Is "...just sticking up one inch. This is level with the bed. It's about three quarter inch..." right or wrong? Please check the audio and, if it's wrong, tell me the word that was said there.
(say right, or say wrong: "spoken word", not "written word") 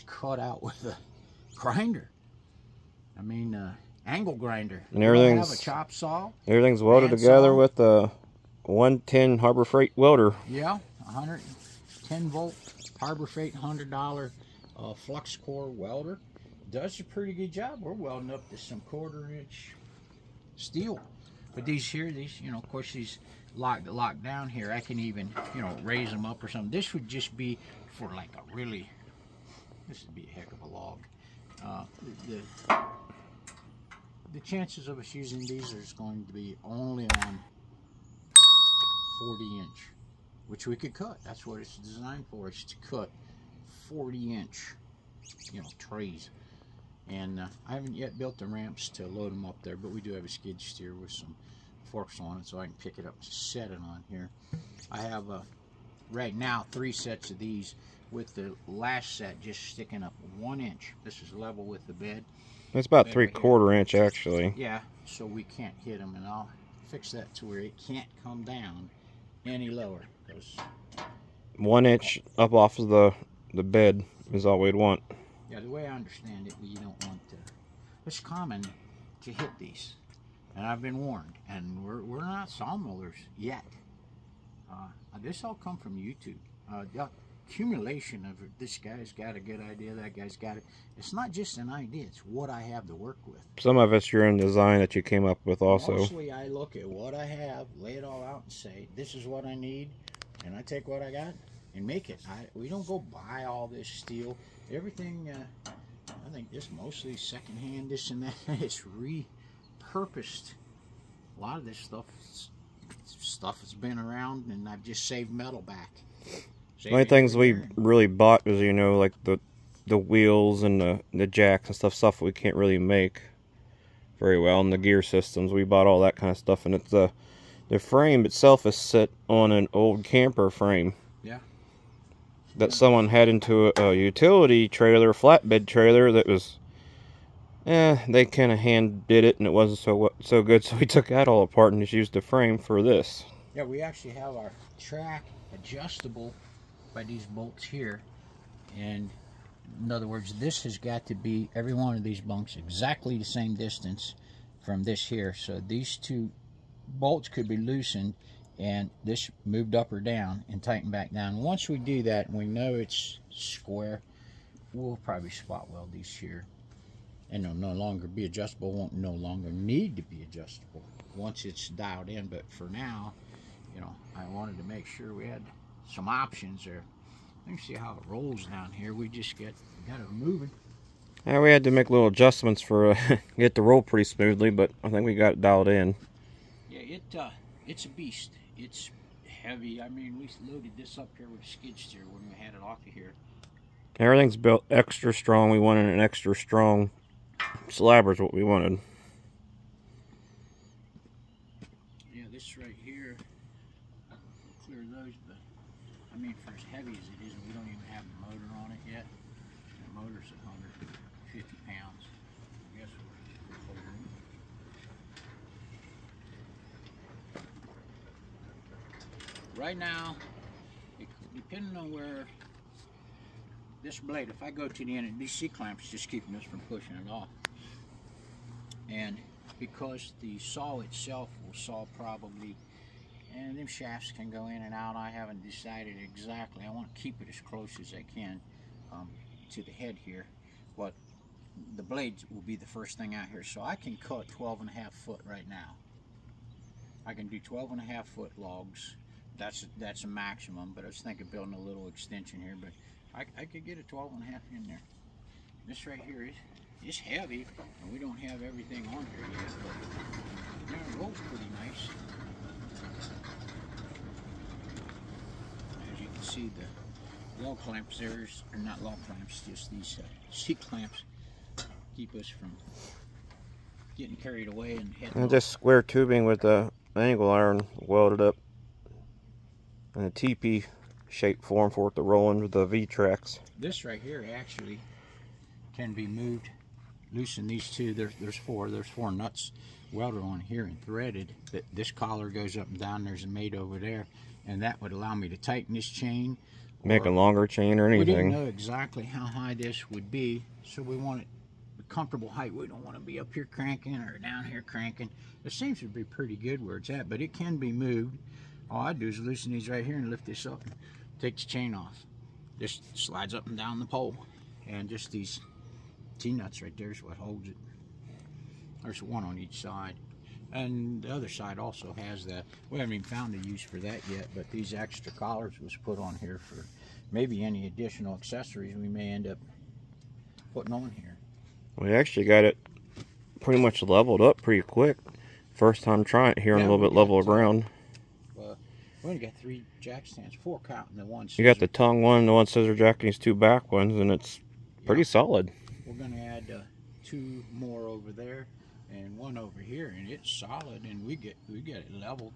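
right.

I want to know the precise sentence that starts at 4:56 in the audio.
Make a longer chain or anything.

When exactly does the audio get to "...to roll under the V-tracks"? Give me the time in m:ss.
4:41.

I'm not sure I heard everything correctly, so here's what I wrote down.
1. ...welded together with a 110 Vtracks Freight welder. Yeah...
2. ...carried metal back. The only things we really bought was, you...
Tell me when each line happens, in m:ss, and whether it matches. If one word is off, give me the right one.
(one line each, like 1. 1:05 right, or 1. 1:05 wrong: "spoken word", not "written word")
1. 0:06 wrong: "Harbor", not "Vtracks"
2. 1:55 wrong: "saved", not "carried".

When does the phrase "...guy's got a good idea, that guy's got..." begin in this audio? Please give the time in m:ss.
1:28.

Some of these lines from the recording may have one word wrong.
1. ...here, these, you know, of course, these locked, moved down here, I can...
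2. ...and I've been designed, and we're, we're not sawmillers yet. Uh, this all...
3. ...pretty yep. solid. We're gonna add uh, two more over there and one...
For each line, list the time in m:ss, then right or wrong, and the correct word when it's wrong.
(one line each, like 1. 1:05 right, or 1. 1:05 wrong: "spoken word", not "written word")
1. 0:21 wrong: "locked", not "moved"
2. 1:20 wrong: "warned", not "designed"
3. 5:44 right.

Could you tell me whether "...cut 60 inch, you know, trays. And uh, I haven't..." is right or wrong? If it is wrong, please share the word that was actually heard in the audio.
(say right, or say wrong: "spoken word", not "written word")
wrong: "40", not "60".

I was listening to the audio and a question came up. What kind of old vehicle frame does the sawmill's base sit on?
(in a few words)
camper frame.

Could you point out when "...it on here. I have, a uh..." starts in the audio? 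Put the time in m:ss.
0:53.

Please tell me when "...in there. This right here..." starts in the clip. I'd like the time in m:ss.
4:14.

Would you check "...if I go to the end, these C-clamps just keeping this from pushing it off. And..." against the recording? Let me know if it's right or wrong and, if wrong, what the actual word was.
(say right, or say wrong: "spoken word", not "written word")
right.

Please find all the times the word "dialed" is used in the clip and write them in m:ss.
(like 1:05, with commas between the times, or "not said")
2:51, 3:05.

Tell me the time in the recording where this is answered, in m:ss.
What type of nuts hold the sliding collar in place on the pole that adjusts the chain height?
5:16.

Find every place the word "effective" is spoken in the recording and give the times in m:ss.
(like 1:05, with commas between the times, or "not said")
not said.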